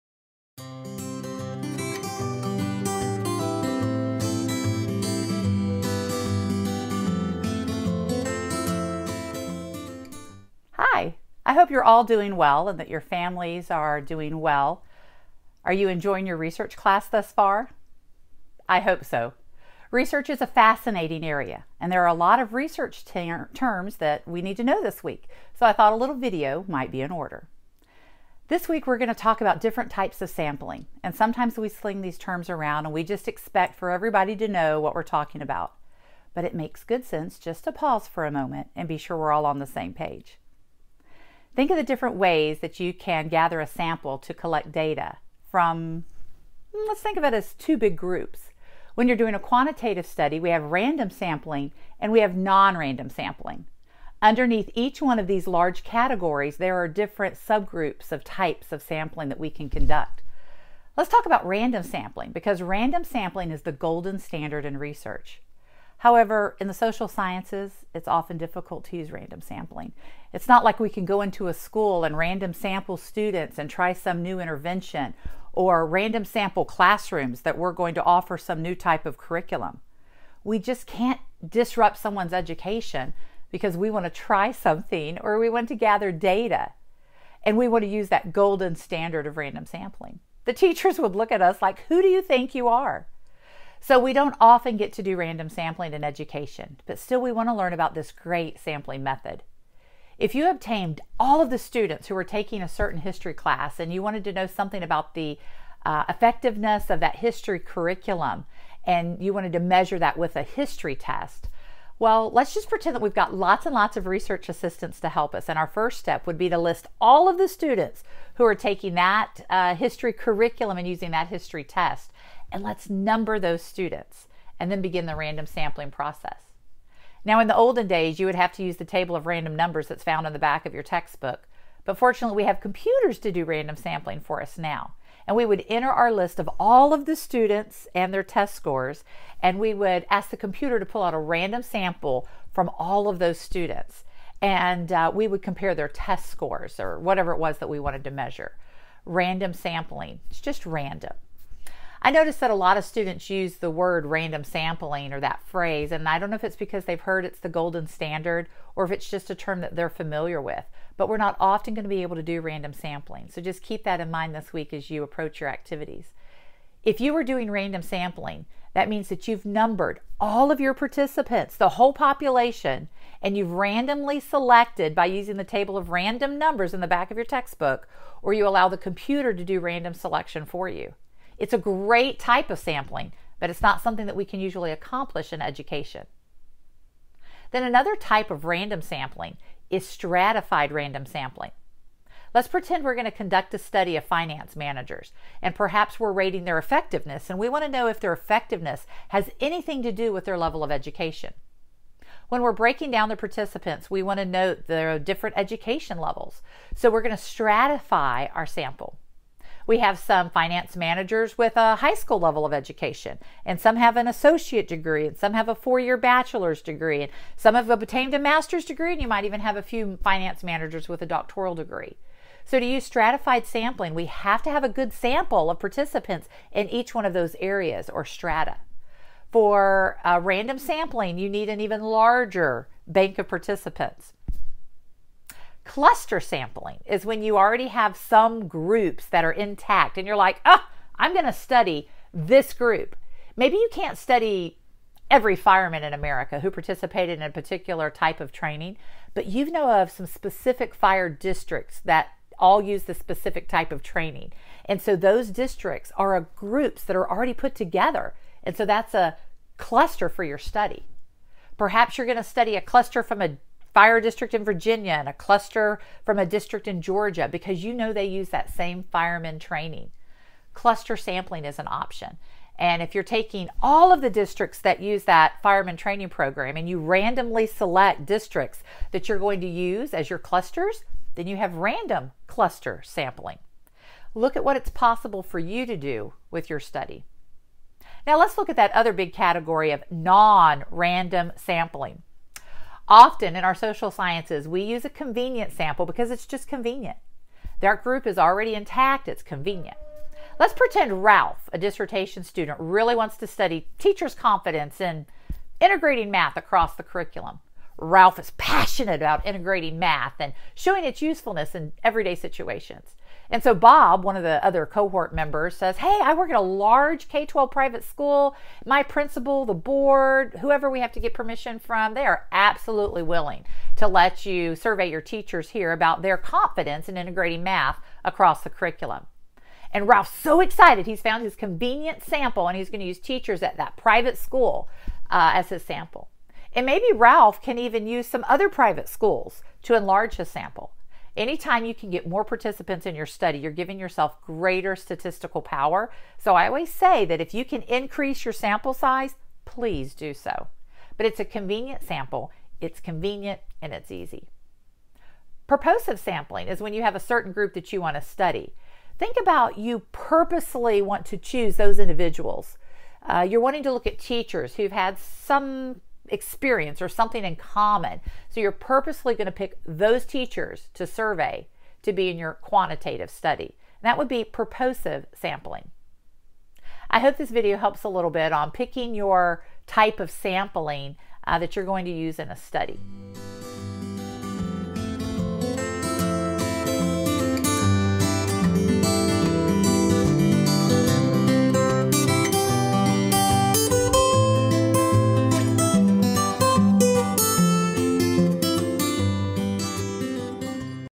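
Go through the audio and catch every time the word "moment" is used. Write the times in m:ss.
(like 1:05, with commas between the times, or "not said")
0:38.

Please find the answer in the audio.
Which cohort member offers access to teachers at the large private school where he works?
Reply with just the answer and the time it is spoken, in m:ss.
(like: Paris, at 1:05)
Bob, at 5:13.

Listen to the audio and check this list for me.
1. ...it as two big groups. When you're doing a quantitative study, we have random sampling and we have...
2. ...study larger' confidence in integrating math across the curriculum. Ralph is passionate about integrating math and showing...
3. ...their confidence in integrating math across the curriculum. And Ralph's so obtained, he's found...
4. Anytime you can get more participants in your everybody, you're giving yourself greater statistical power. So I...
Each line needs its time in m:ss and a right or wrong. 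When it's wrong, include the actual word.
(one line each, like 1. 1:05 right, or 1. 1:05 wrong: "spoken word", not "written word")
1. 0:47 right
2. 5:03 wrong: "teachers", not "larger"
3. 5:26 wrong: "excited", not "obtained"
4. 5:41 wrong: "study", not "everybody".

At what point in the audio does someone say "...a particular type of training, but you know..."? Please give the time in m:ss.
4:07.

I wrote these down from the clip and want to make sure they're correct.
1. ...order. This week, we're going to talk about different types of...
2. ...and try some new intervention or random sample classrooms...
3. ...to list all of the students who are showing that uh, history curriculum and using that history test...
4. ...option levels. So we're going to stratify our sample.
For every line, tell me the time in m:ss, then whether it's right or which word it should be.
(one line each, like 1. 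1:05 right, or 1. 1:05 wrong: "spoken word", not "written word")
1. 0:27 right
2. 1:13 right
3. 1:56 wrong: "taking", not "showing"
4. 3:25 wrong: "education", not "option".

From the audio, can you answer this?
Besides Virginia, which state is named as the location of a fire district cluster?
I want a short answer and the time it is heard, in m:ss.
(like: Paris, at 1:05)
Georgia, at 4:26.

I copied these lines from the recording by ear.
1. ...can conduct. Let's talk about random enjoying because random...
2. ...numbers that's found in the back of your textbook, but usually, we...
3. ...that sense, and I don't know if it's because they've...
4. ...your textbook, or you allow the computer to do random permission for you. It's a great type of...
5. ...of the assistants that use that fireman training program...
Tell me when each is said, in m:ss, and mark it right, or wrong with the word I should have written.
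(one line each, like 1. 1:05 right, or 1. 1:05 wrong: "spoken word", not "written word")
1. 0:59 wrong: "sampling", not "enjoying"
2. 2:09 wrong: "fortunately", not "usually"
3. 2:35 wrong: "phrase", not "sense"
4. 2:57 wrong: "selection", not "permission"
5. 4:33 wrong: "districts", not "assistants".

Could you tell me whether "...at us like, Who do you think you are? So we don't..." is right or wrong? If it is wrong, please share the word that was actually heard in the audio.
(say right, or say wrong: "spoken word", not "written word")
right.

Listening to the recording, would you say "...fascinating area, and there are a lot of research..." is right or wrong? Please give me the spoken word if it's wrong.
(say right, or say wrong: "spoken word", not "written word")
right.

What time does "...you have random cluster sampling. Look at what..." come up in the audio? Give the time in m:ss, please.
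4:41.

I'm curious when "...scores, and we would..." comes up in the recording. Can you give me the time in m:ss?
2:18.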